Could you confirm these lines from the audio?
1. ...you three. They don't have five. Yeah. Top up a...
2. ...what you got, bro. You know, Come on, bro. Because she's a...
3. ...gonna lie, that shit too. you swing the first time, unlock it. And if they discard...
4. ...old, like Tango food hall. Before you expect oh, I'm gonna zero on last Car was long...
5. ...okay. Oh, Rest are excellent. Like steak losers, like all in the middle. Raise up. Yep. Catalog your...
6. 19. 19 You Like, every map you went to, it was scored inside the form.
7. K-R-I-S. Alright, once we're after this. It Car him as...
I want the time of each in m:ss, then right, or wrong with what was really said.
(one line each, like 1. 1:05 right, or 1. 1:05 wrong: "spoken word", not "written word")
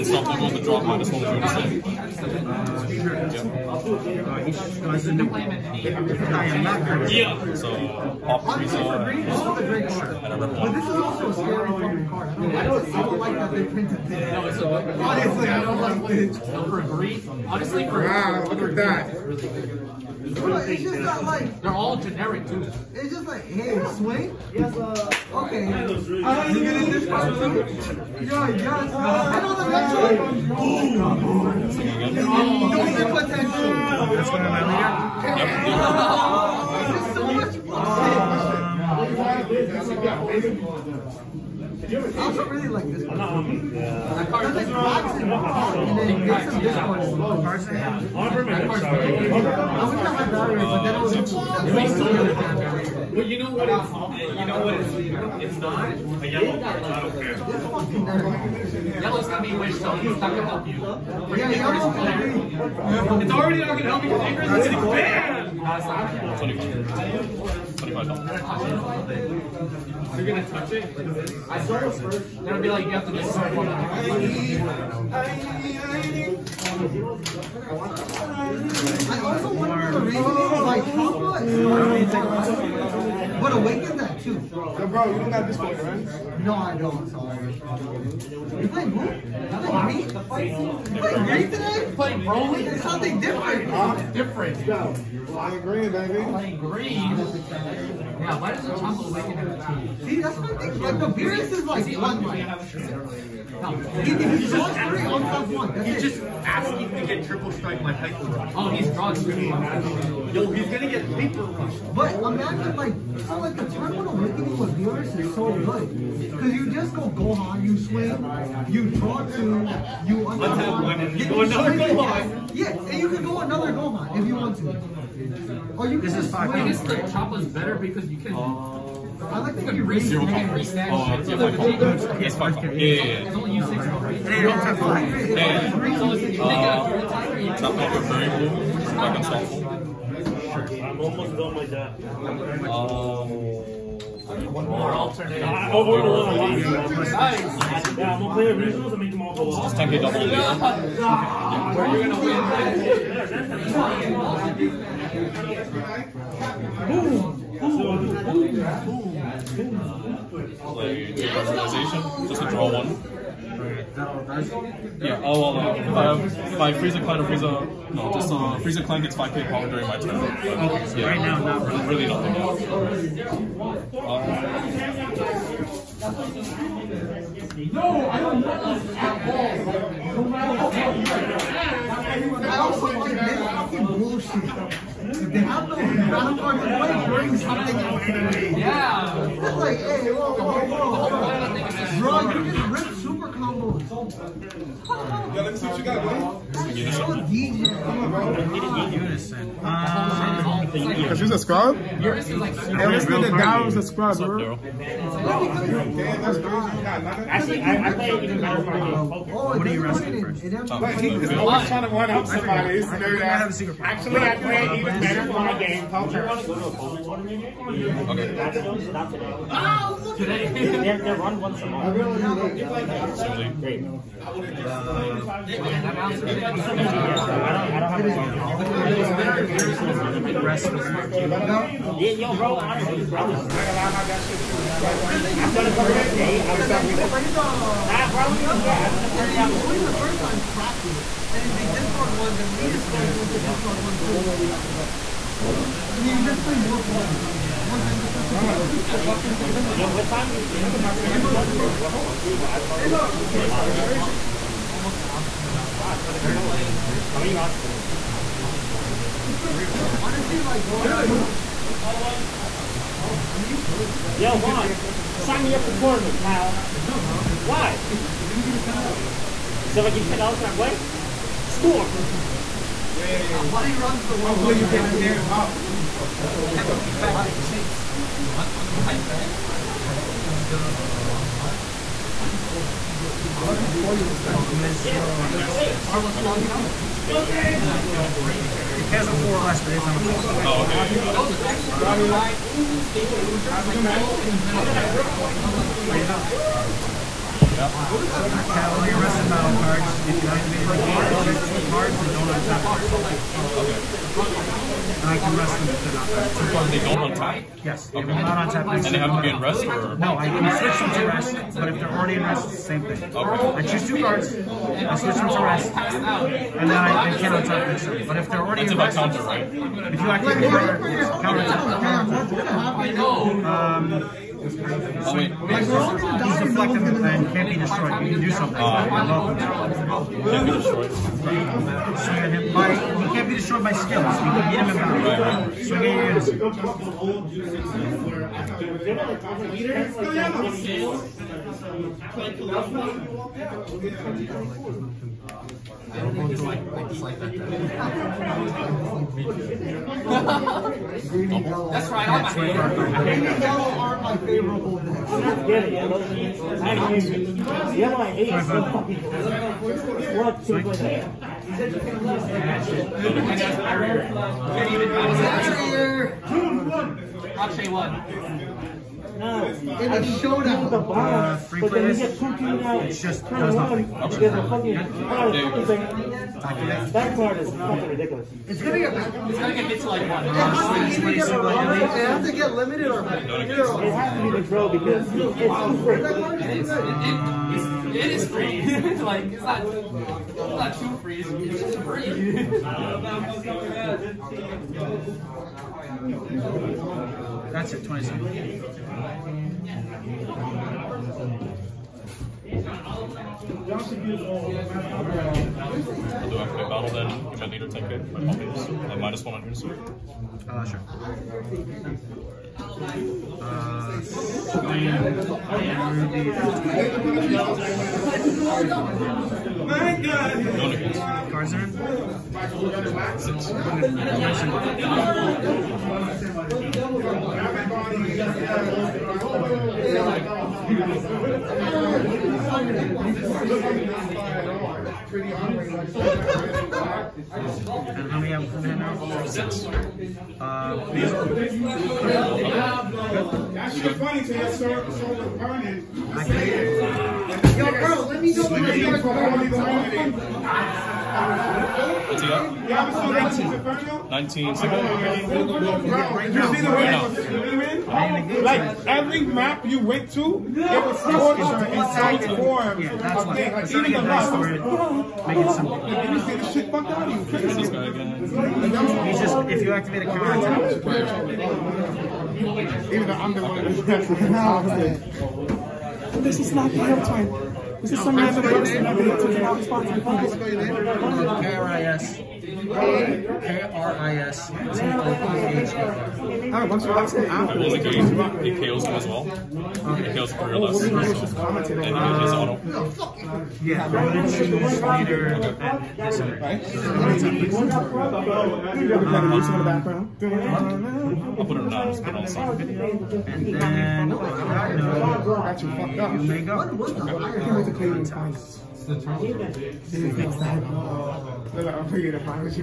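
1. 2:13 wrong: "six", not "three"
2. 3:15 right
3. 3:53 wrong: "crack", not "unlock"
4. 4:42 right
5. 4:50 wrong: "Those", not "Rest"
6. 7:32 right
7. 8:02 wrong: "KOs", not "Car".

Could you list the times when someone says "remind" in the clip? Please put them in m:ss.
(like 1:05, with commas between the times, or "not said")
not said.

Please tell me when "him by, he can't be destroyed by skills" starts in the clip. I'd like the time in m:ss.
5:30.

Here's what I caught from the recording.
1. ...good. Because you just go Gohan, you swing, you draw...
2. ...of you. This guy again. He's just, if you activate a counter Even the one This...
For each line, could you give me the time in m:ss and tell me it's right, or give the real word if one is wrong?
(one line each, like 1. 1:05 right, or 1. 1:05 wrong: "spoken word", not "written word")
1. 1:55 right
2. 7:47 right.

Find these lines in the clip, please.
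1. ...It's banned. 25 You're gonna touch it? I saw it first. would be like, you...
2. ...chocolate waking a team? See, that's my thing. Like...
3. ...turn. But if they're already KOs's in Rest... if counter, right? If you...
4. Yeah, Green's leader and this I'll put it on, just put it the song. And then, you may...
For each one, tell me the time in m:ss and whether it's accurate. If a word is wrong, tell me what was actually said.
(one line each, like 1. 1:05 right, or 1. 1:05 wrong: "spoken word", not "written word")
1. 1:04 right
2. 1:38 right
3. 5:17 wrong: "That", not "KOs"
4. 8:13 wrong: "Revolution", not "Green".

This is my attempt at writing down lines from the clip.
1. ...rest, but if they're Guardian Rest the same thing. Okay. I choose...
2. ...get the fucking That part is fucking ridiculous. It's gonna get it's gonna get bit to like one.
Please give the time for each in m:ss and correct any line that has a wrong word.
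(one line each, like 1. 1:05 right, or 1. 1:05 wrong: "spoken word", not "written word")
1. 5:11 right
2. 6:14 right.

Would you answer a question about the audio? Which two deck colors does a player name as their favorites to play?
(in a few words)
Green and yellow.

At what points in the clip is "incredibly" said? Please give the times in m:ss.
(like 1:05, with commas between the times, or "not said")
not said.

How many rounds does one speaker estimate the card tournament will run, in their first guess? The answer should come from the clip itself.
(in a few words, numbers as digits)
4.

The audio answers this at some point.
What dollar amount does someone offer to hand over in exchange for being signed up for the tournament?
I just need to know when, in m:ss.
4:30.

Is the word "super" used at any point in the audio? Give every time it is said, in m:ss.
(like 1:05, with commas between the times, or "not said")
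3:12, 4:42.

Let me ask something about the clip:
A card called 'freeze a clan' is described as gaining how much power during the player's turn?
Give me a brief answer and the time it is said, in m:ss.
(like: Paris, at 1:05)
5k, at 2:49.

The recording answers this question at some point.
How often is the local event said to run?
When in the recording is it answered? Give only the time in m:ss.
3:41.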